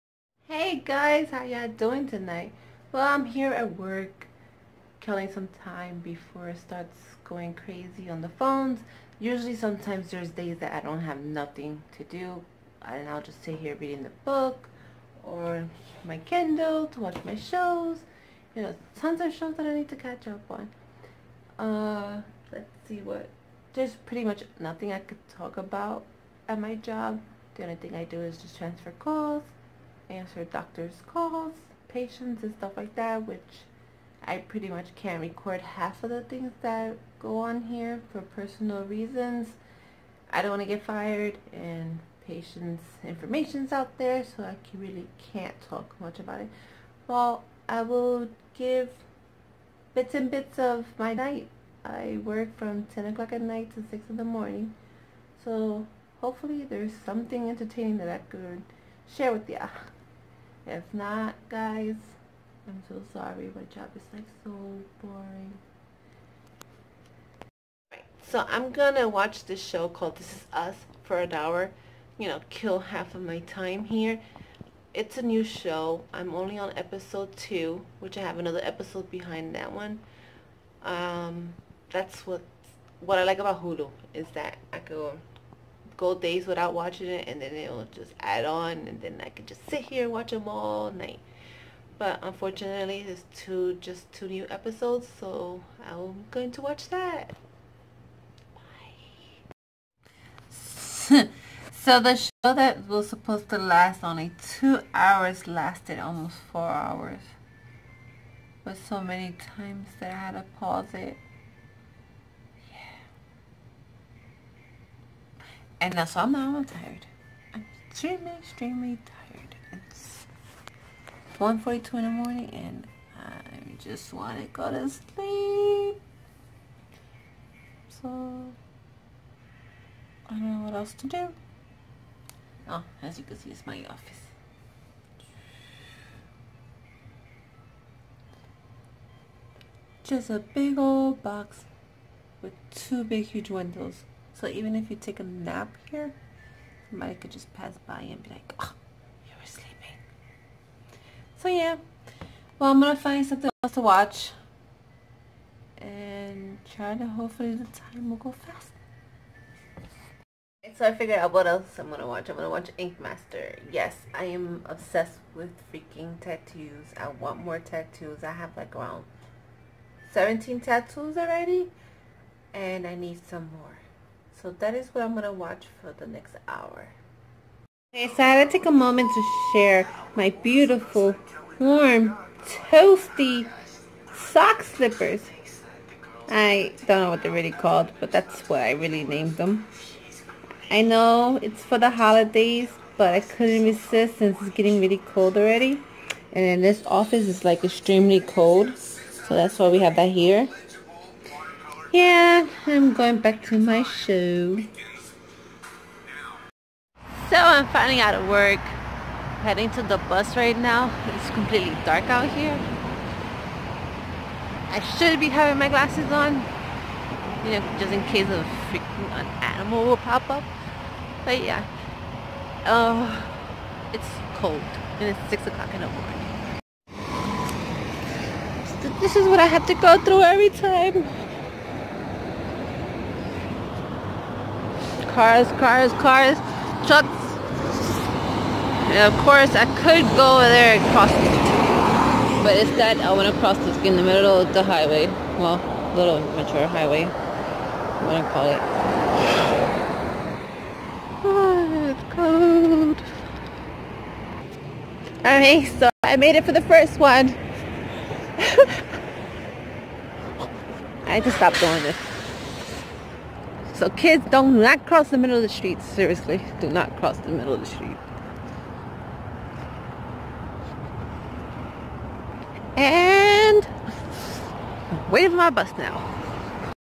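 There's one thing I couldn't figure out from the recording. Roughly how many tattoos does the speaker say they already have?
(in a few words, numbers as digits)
17.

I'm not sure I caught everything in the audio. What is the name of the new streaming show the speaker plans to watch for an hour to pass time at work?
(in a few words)
This Is Us.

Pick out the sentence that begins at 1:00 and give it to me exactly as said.
If not, guys, I'm so sorry.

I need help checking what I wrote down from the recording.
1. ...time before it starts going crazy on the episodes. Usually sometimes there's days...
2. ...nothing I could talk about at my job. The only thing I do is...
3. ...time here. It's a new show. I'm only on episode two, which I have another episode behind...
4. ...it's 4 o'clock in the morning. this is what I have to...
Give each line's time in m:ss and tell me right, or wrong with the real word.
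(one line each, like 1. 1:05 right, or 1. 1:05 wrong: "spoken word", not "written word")
1. 0:05 wrong: "phones", not "episodes"
2. 0:24 right
3. 1:13 right
4. 3:45 wrong: "6", not "4".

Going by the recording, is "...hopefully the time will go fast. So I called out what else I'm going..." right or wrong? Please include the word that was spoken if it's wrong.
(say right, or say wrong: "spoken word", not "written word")
wrong: "figured", not "called".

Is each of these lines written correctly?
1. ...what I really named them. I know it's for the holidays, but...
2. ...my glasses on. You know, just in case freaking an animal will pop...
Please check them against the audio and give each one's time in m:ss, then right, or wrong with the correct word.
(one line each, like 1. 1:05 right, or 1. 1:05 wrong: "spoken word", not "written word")
1. 3:08 right
2. 3:35 right.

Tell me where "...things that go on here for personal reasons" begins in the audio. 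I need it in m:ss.
0:36.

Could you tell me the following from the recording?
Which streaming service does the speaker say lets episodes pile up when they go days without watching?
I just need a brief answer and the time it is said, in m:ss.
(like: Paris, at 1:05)
Hulu, at 1:23.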